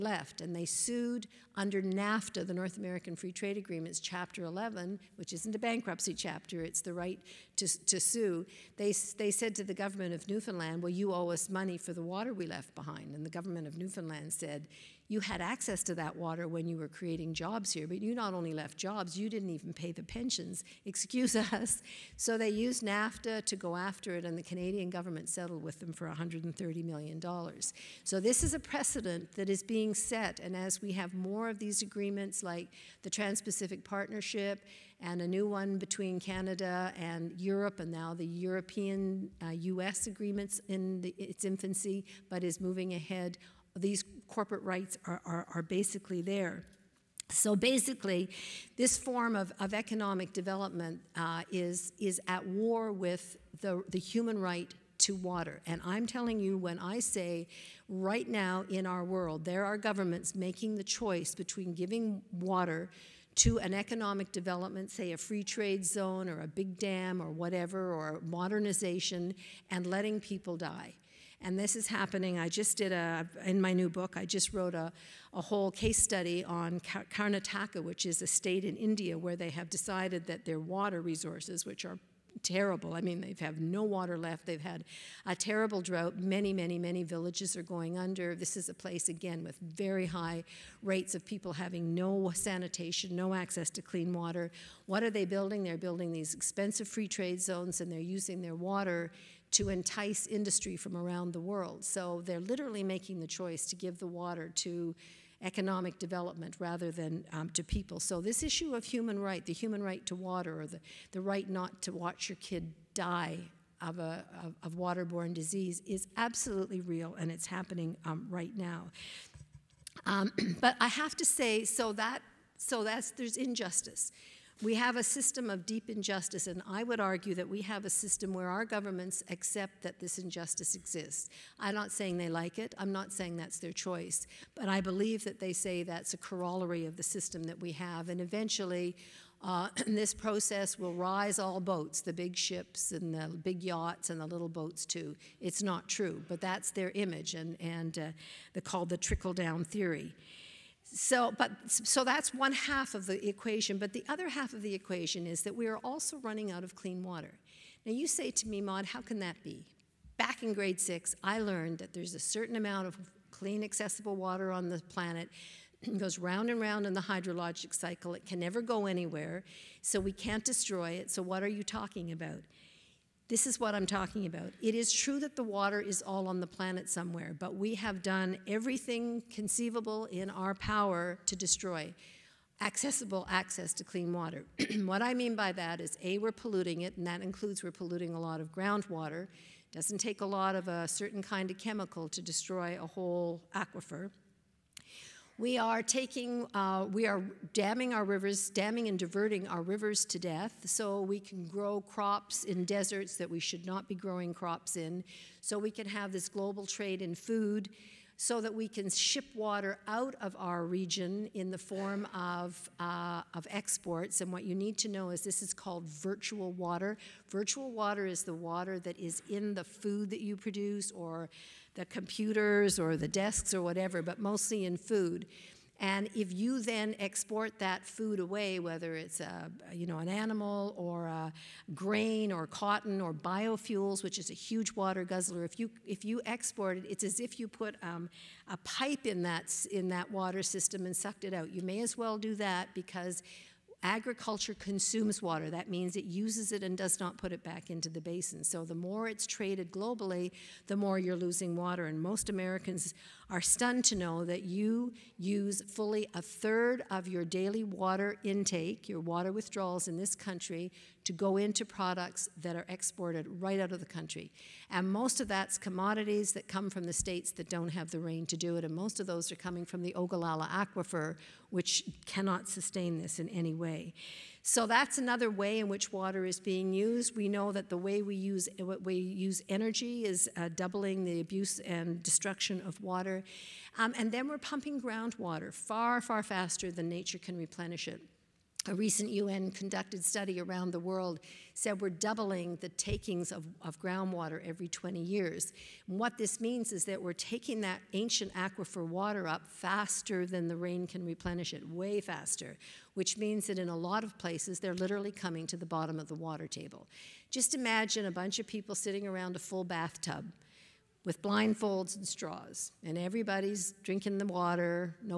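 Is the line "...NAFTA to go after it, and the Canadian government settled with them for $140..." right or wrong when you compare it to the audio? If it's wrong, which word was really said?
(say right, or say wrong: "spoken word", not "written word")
wrong: "130", not "140".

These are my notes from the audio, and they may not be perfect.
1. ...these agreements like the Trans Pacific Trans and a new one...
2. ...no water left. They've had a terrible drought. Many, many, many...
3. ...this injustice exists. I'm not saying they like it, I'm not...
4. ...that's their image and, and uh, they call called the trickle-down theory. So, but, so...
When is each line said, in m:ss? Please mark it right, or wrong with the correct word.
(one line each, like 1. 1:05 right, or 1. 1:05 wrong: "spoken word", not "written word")
1. 0:31 wrong: "Partnership", not "Trans"
2. 1:23 right
3. 2:09 right
4. 2:26 right.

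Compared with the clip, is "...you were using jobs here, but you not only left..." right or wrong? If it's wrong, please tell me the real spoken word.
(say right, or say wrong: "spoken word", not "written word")
wrong: "creating", not "using".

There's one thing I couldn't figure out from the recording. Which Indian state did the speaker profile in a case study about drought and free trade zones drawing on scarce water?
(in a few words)
Karnataka.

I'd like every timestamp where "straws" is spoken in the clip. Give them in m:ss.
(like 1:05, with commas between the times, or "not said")
5:12.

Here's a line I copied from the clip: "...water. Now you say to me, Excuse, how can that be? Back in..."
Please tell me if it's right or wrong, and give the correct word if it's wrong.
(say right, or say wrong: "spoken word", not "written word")
wrong: "Maude", not "Excuse".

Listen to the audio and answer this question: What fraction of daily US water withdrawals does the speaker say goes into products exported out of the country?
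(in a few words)
a third.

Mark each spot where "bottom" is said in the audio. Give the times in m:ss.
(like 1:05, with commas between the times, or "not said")
5:05.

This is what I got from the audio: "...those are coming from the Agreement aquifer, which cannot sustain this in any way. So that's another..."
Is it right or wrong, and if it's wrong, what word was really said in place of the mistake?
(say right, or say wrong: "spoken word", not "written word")
wrong: "Ogallala", not "Agreement".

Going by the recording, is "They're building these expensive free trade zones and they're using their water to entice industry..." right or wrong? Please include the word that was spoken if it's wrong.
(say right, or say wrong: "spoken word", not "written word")
right.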